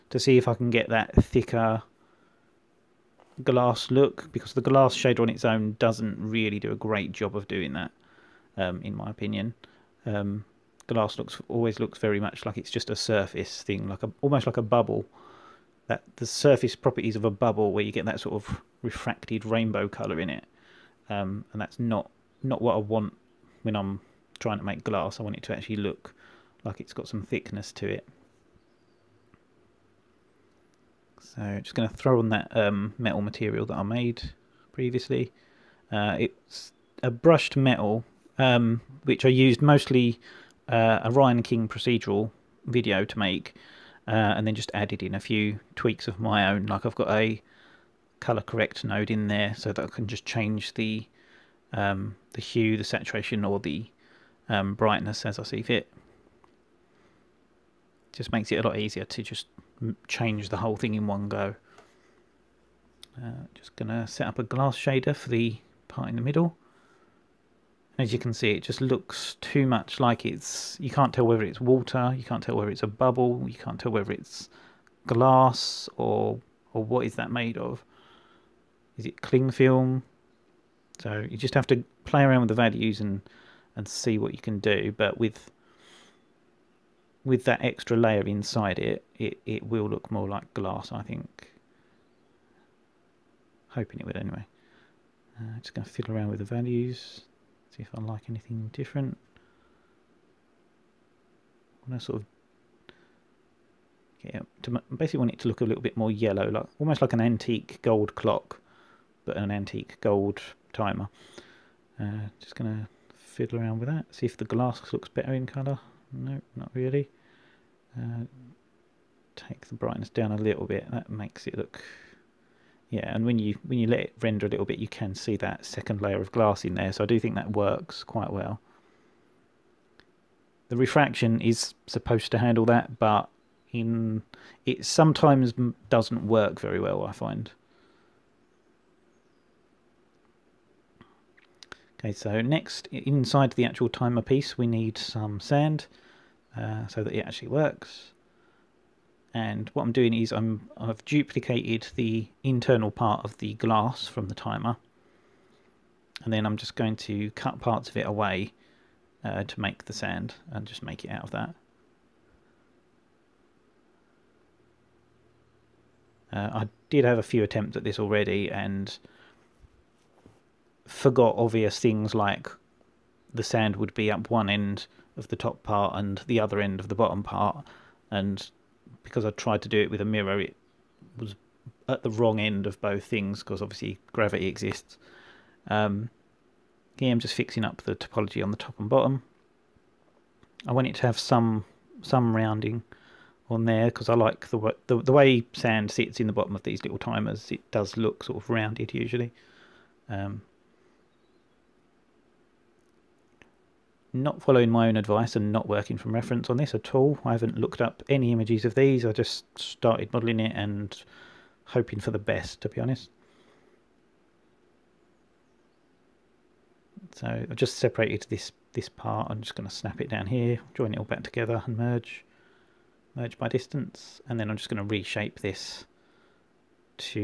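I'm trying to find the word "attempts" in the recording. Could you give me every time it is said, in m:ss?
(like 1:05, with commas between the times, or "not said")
2:47.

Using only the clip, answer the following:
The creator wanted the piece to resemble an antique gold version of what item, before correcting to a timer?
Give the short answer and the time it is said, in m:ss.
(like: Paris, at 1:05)
clock, at 1:48.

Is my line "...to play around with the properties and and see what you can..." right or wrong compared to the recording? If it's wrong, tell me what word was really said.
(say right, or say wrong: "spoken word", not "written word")
wrong: "values", not "properties".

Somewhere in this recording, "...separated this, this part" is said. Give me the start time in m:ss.
3:37.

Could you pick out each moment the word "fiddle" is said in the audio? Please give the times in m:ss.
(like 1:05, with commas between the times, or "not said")
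1:35, 1:53.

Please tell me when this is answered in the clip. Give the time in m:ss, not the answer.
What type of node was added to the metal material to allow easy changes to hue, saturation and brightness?
0:48.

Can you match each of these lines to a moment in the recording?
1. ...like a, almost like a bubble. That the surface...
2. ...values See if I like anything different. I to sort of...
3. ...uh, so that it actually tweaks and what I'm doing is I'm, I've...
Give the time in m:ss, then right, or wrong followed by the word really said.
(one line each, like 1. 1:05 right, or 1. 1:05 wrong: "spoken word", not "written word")
1. 0:13 right
2. 1:36 right
3. 2:26 wrong: "works", not "tweaks".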